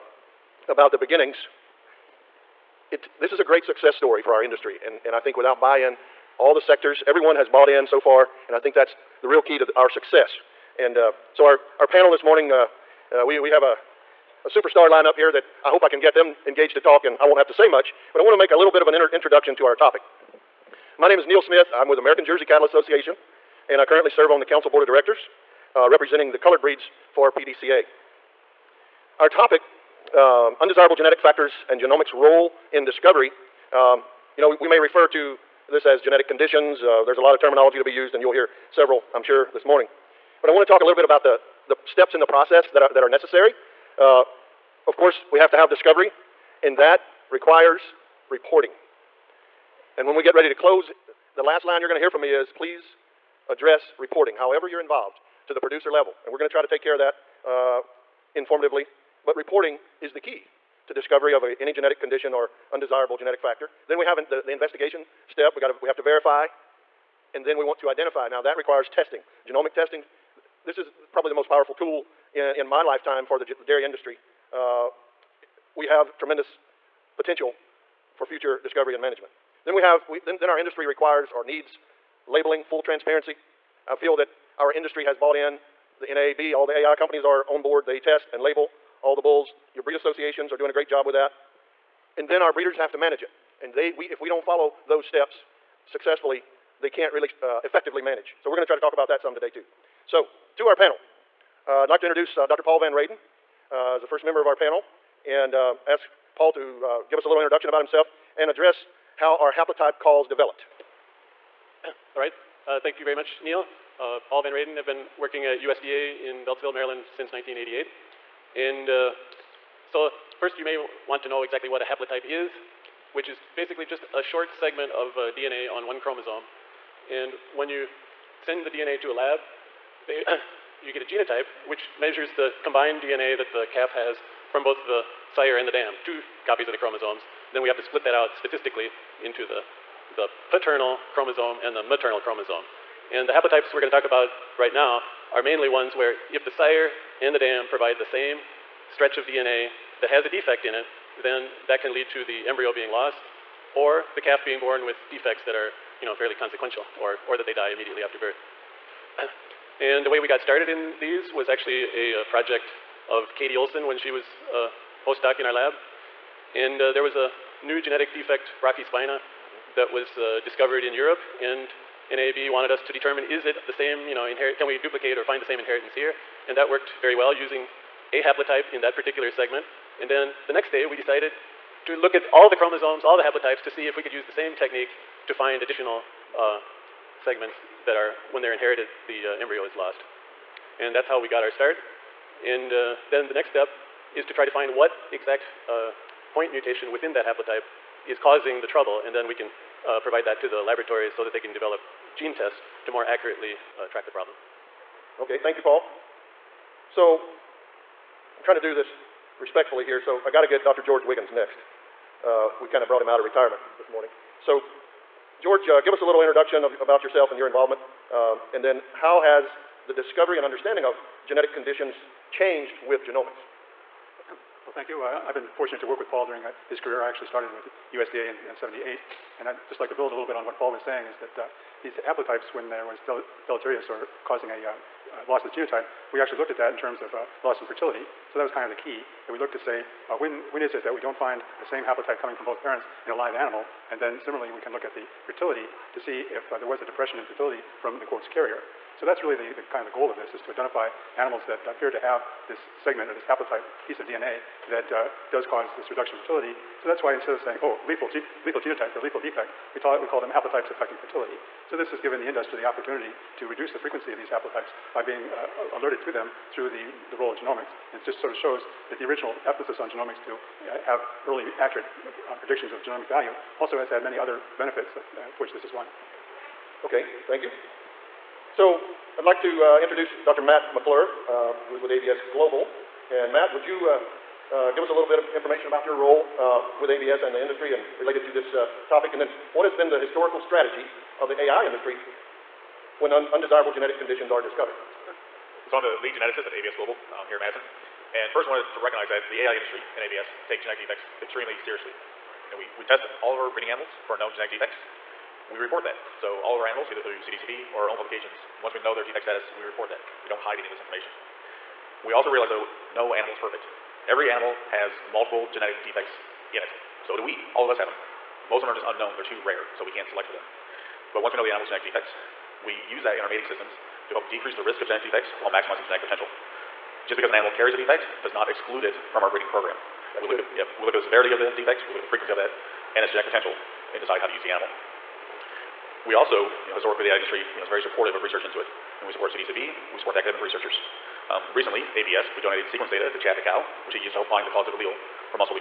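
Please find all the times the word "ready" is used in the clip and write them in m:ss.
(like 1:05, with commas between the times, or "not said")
0:50.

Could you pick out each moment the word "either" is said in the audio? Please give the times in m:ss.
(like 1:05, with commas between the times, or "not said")
5:06.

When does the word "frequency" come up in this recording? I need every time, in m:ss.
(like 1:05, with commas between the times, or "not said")
4:23, 5:32.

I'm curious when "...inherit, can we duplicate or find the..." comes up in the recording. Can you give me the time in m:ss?
2:54.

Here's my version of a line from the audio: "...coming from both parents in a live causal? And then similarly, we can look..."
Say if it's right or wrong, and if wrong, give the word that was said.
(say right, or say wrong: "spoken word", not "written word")
wrong: "animal", not "causal".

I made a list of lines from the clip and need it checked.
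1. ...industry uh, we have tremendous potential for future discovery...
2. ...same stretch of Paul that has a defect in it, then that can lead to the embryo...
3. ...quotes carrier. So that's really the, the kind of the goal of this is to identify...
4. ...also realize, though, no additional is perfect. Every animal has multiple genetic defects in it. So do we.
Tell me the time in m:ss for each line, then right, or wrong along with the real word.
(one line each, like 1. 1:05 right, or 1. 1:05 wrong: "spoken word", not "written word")
1. 1:13 right
2. 2:28 wrong: "DNA", not "Paul"
3. 4:08 right
4. 5:12 wrong: "animal", not "additional".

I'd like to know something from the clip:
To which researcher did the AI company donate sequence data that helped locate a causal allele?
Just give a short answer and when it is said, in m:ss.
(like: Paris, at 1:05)
Chad Dechow, at 5:43.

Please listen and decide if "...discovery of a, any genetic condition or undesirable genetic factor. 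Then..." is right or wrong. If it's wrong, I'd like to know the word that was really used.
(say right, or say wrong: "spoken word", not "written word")
right.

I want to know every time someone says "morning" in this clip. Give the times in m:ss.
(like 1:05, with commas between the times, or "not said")
0:12, 0:39, 3:33.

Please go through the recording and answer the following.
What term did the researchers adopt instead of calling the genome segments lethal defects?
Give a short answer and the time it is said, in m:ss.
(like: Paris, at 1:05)
Haplotypes affecting fertility, at 4:20.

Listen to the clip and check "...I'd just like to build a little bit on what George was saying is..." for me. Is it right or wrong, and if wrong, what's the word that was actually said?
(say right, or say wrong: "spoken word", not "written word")
wrong: "Paul", not "George".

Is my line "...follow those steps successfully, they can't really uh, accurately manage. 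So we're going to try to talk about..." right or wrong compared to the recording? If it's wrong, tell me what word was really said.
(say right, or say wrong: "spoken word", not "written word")
wrong: "effectively", not "accurately".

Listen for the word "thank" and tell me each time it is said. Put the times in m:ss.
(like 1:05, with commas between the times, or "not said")
1:52, 3:25, 3:44, 4:37.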